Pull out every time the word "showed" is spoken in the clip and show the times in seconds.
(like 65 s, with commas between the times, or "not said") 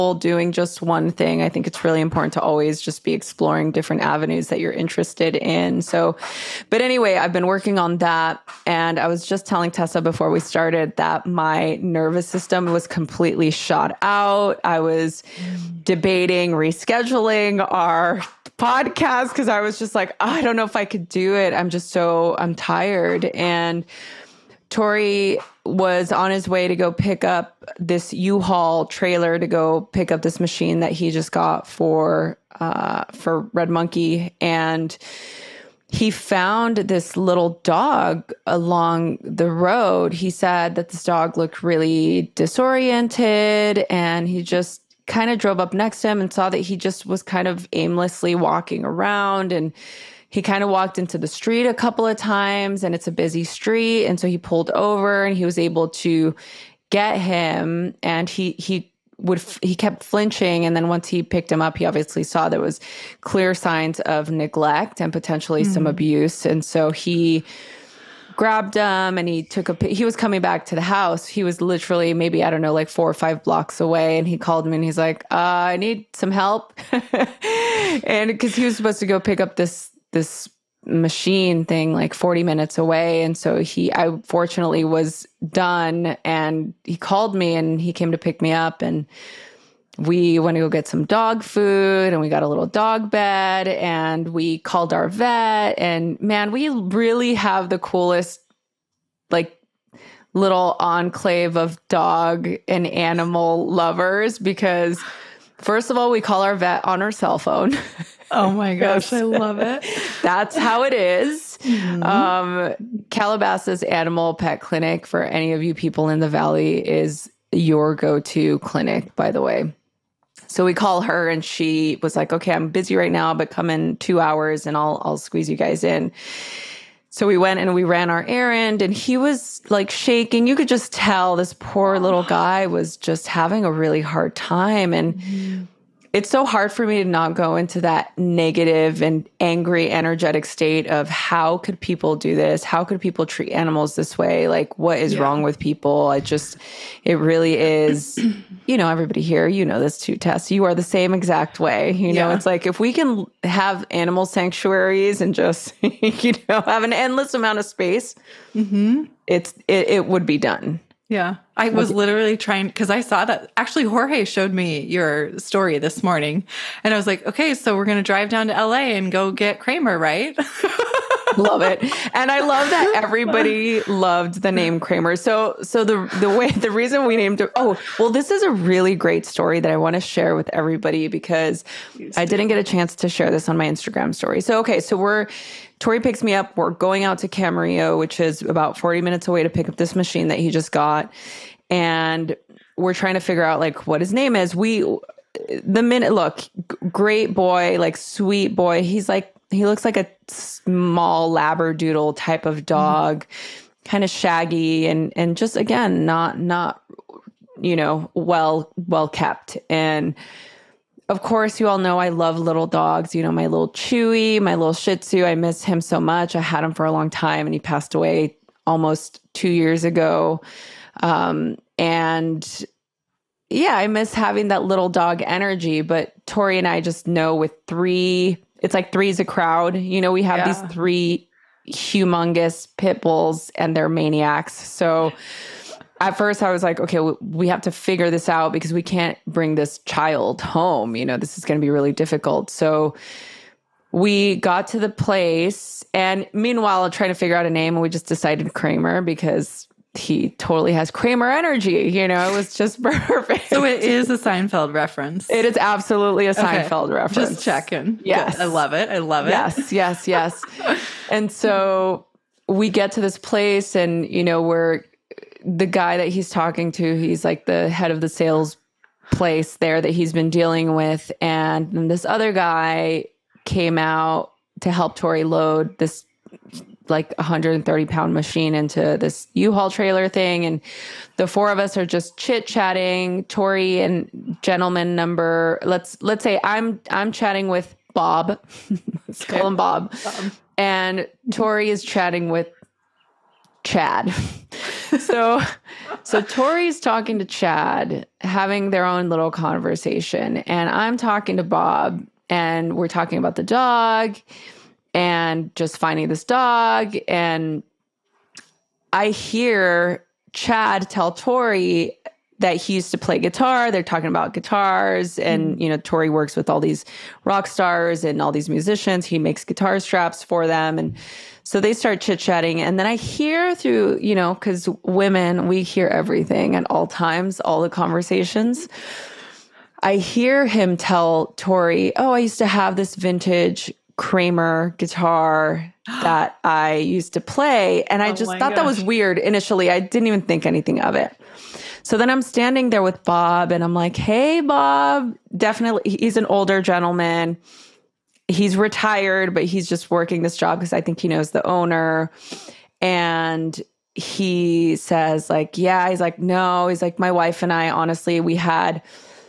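164 s.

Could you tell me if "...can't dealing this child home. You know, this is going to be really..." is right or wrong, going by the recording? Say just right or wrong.
wrong.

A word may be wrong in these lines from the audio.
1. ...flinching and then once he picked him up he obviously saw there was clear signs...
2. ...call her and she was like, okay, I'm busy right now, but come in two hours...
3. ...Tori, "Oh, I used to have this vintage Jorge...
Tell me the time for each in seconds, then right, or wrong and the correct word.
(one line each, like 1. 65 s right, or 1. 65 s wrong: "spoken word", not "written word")
1. 60 s right
2. 120 s right
3. 331 s wrong: "Kramer", not "Jorge".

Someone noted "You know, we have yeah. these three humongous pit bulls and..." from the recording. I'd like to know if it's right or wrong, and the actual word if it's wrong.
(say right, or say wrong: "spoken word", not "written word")
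right.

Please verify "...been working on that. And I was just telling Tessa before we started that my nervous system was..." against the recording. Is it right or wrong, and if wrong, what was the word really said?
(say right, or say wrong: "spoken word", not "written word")
right.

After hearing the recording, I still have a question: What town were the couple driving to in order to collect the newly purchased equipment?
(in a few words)
Camarillo.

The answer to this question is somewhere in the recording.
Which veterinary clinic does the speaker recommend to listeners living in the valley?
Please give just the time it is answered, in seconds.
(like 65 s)
113 s.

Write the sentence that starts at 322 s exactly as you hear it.
And then I hear through, you know, because women we hear everything at all times, all the conversations.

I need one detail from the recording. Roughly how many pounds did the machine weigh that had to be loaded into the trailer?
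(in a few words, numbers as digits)
130.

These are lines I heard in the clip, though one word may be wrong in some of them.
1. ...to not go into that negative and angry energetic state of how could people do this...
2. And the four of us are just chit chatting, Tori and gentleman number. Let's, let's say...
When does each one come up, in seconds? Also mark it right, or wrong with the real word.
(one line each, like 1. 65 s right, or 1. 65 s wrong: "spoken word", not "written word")
1. 137 s right
2. 280 s right.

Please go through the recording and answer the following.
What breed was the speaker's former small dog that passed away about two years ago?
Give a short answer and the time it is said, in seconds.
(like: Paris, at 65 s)
Shih Tzu, at 214 s.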